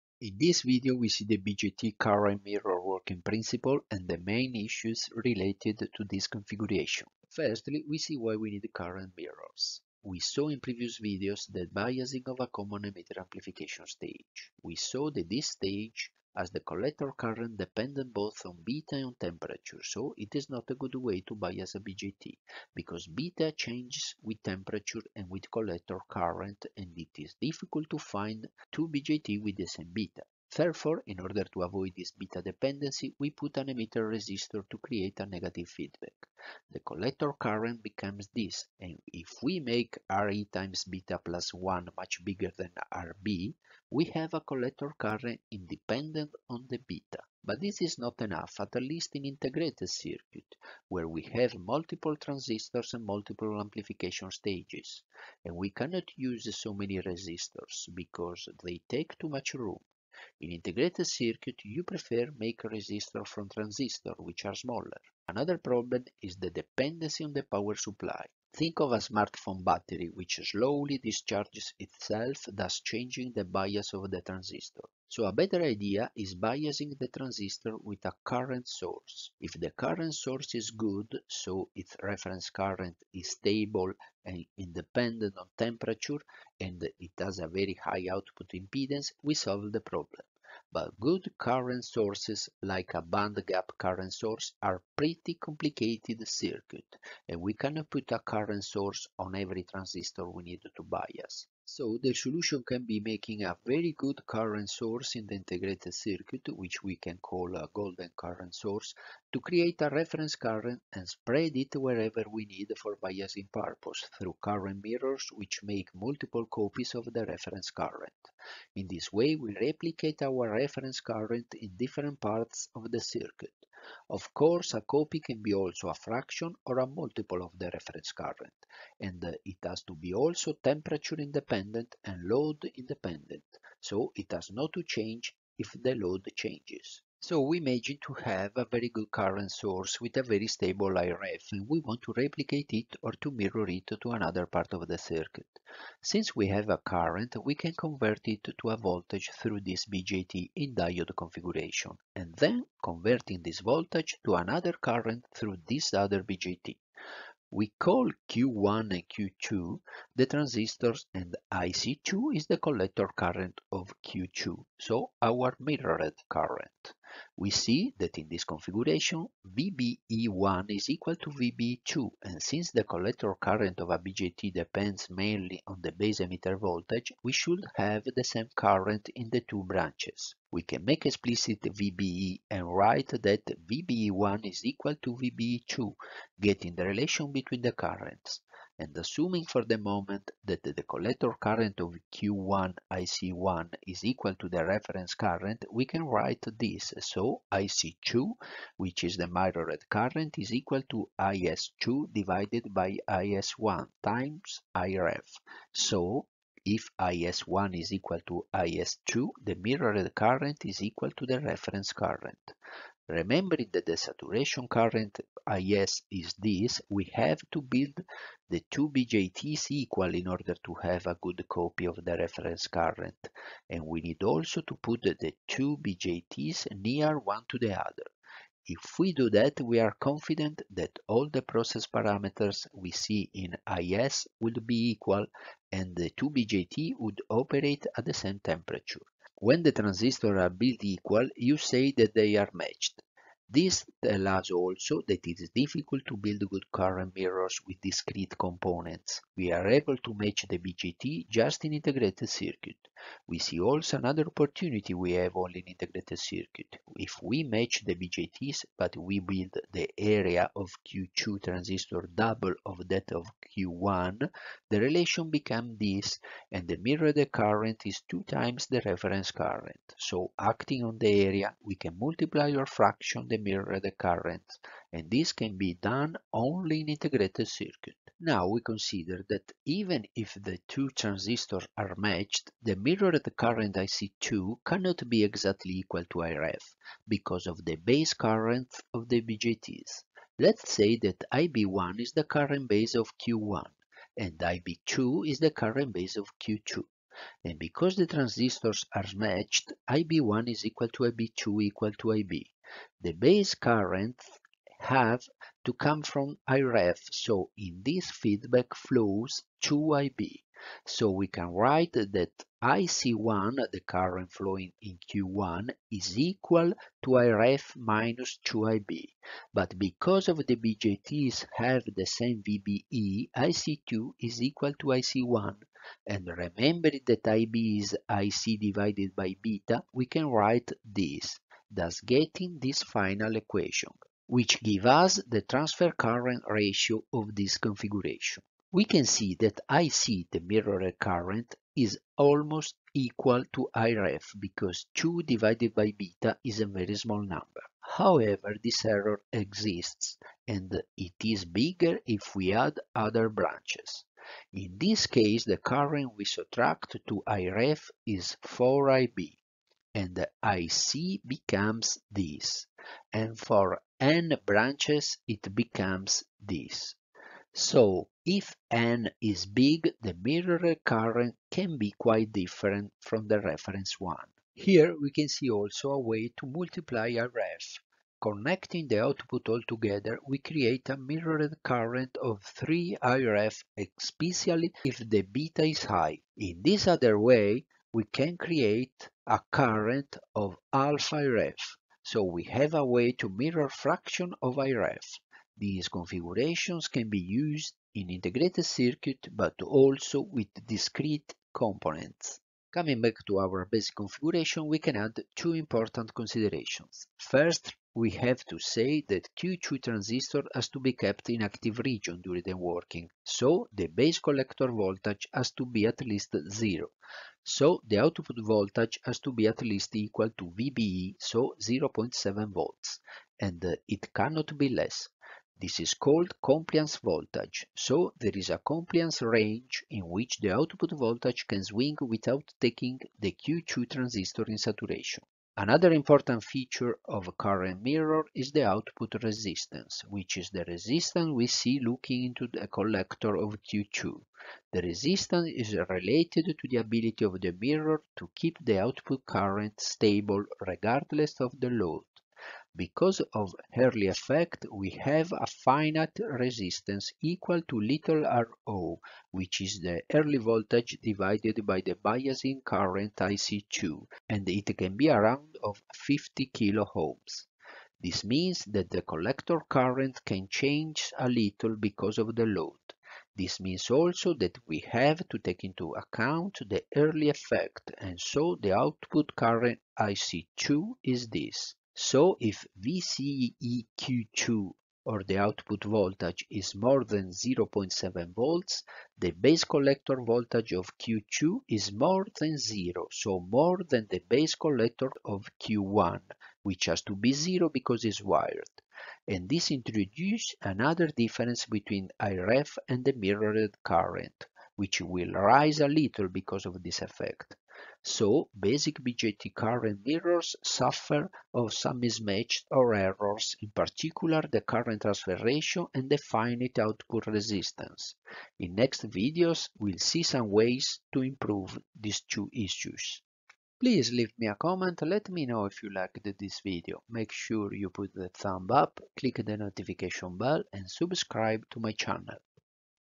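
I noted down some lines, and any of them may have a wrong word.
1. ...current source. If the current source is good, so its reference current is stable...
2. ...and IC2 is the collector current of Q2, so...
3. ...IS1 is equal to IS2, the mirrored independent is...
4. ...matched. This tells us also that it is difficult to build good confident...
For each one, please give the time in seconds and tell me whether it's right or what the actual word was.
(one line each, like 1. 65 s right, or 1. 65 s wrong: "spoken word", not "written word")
1. 78 s right
2. 161 s right
3. 206 s wrong: "current", not "independent"
4. 242 s wrong: "current", not "confident".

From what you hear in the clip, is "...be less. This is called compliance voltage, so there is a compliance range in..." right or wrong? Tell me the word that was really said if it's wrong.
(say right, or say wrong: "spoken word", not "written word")
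right.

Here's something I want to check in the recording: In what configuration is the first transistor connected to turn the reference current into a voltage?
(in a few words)
Diode configuration.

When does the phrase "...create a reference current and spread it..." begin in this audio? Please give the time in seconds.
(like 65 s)
109 s.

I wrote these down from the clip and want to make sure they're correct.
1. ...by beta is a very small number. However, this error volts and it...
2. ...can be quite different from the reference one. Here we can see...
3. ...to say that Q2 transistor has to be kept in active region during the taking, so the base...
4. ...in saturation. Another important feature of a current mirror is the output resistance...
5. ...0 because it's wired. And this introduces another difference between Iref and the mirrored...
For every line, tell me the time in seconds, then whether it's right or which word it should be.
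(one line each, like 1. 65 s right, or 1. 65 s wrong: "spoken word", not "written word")
1. 345 s wrong: "exists", not "volts"
2. 371 s right
3. 408 s wrong: "working", not "taking"
4. 434 s right
5. 497 s right.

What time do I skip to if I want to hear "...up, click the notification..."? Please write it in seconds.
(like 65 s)
528 s.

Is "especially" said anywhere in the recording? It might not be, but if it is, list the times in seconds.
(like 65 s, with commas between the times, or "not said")
383 s.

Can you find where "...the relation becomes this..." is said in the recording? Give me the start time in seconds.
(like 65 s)
264 s.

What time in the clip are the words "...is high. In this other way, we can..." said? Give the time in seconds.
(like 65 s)
385 s.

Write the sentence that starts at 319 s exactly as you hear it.
But because of the BJTs have the same VBE, IC2 is equal to IC1.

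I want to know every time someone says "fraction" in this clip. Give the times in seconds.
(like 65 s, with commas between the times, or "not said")
125 s, 272 s, 393 s.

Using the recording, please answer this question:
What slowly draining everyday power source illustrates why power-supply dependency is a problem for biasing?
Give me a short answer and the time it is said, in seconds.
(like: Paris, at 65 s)
Smartphone battery, at 68 s.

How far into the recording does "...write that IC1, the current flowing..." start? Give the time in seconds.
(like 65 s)
311 s.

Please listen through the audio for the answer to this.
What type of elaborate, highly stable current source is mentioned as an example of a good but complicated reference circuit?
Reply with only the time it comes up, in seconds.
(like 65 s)
93 s.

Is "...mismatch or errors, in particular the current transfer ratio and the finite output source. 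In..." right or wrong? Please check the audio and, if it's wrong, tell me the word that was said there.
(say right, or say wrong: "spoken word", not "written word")
wrong: "resistance", not "source".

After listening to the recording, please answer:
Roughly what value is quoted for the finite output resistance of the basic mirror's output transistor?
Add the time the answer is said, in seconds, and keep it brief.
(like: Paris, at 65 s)
50 kΩ, at 465 s.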